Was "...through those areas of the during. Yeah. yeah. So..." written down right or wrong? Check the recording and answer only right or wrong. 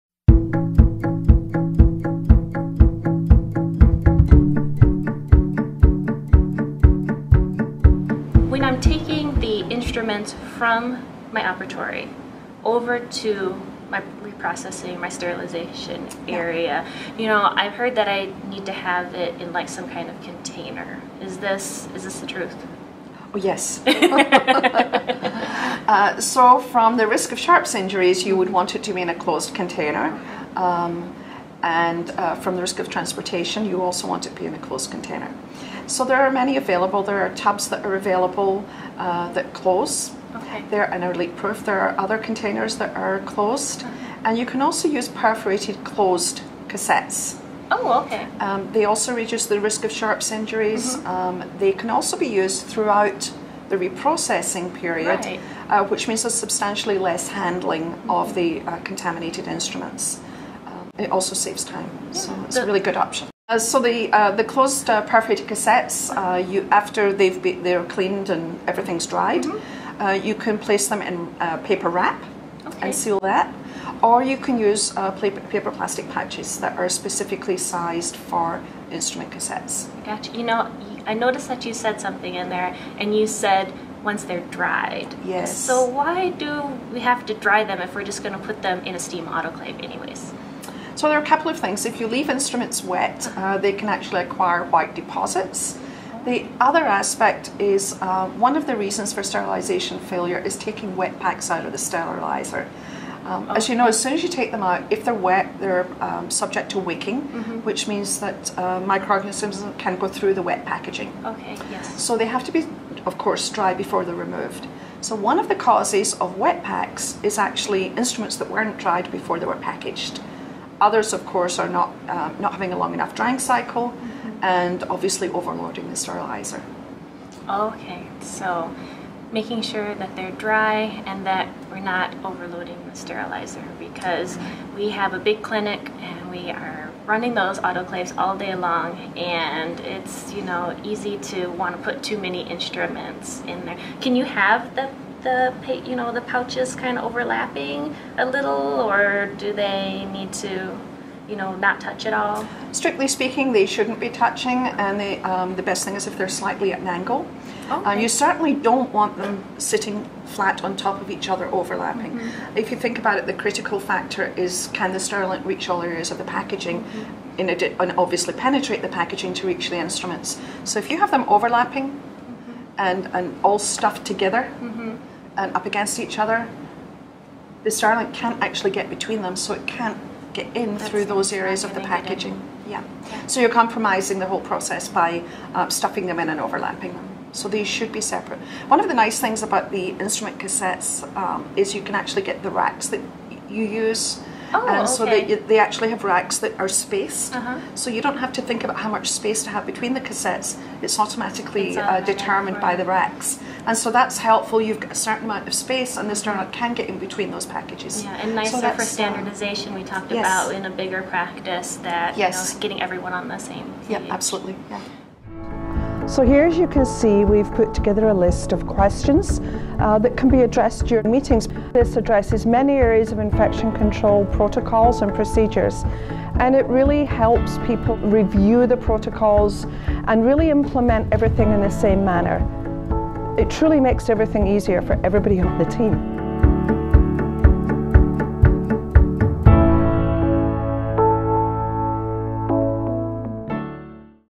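wrong.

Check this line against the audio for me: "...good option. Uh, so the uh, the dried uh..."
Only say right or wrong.
wrong.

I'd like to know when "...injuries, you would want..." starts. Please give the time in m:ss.
0:27.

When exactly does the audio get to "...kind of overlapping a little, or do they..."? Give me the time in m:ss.
2:26.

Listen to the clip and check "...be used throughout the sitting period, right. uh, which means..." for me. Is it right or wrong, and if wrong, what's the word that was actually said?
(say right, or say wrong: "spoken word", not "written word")
wrong: "reprocessing", not "sitting".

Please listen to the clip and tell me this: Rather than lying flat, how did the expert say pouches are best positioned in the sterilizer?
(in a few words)
Slightly at an angle.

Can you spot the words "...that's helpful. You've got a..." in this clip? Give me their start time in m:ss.
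3:23.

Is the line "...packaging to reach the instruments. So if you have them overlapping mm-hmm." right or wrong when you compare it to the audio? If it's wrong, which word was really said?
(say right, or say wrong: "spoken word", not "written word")
right.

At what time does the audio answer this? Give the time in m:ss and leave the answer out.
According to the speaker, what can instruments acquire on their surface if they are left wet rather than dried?
1:34.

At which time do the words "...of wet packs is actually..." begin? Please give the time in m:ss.
1:56.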